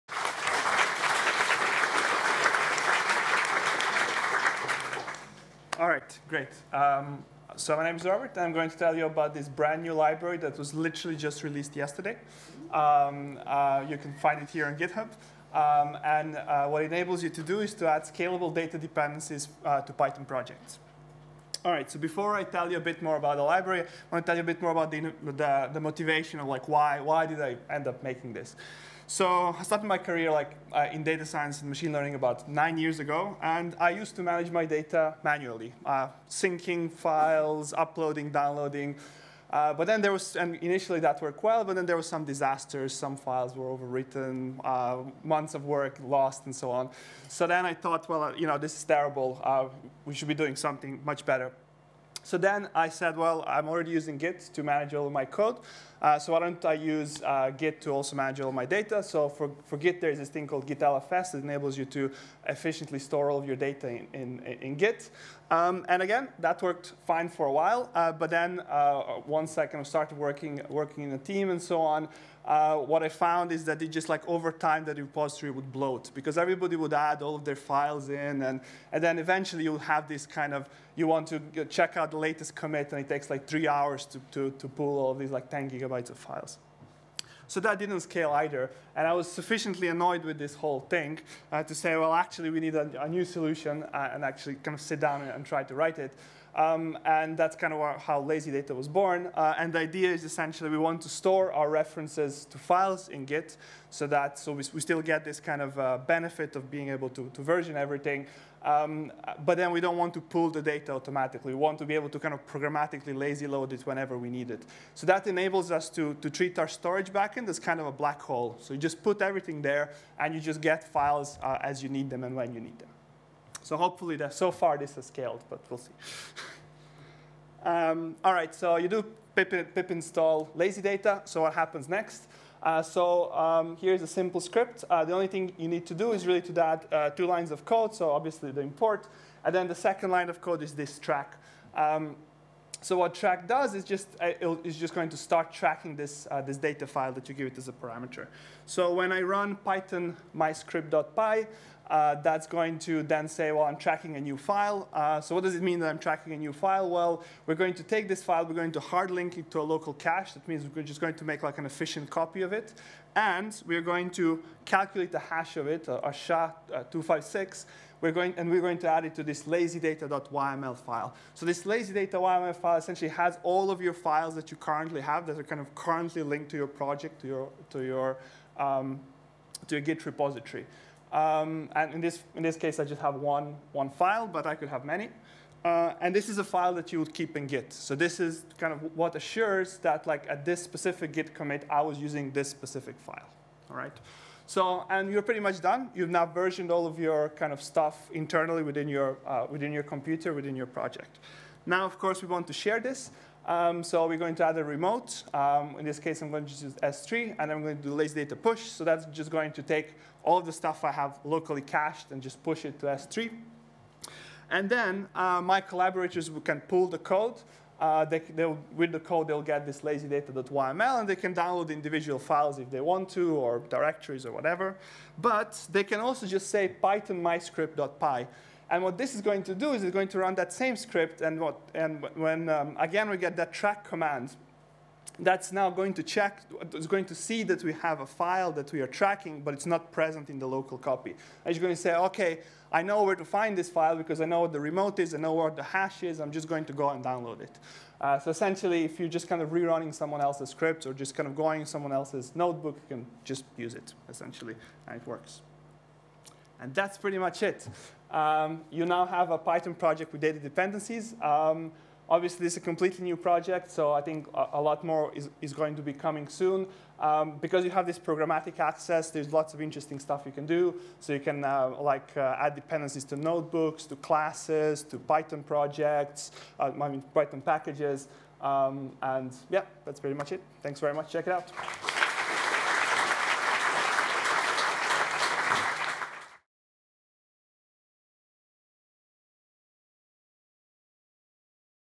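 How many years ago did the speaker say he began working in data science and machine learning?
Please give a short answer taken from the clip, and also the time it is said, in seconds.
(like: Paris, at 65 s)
9, at 32 s.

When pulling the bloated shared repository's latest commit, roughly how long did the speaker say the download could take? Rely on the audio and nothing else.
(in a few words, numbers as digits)
3 hours.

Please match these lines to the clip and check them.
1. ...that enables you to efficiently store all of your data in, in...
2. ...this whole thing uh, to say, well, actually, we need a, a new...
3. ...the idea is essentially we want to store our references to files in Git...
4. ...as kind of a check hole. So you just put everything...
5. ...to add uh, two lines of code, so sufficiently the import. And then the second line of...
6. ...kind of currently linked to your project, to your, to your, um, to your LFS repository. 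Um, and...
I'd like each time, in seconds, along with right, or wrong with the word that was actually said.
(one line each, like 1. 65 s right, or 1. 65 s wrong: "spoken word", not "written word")
1. 61 s right
2. 90 s right
3. 99 s right
4. 117 s wrong: "black", not "check"
5. 136 s wrong: "obviously", not "sufficiently"
6. 175 s wrong: "Git", not "LFS".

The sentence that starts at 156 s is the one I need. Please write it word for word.
Well, we're going to take this file, we're going to hard link it to a local cache.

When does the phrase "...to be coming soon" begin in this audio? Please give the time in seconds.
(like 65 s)
265 s.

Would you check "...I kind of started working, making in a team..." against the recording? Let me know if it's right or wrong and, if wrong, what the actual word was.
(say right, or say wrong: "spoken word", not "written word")
wrong: "working", not "making".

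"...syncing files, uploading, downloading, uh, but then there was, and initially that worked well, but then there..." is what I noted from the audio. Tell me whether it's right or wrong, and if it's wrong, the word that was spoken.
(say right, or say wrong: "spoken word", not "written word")
right.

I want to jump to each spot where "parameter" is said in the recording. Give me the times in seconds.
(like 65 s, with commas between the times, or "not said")
147 s.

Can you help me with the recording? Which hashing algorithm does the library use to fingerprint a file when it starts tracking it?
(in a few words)
SHA-256.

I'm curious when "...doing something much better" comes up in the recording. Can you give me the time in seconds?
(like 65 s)
50 s.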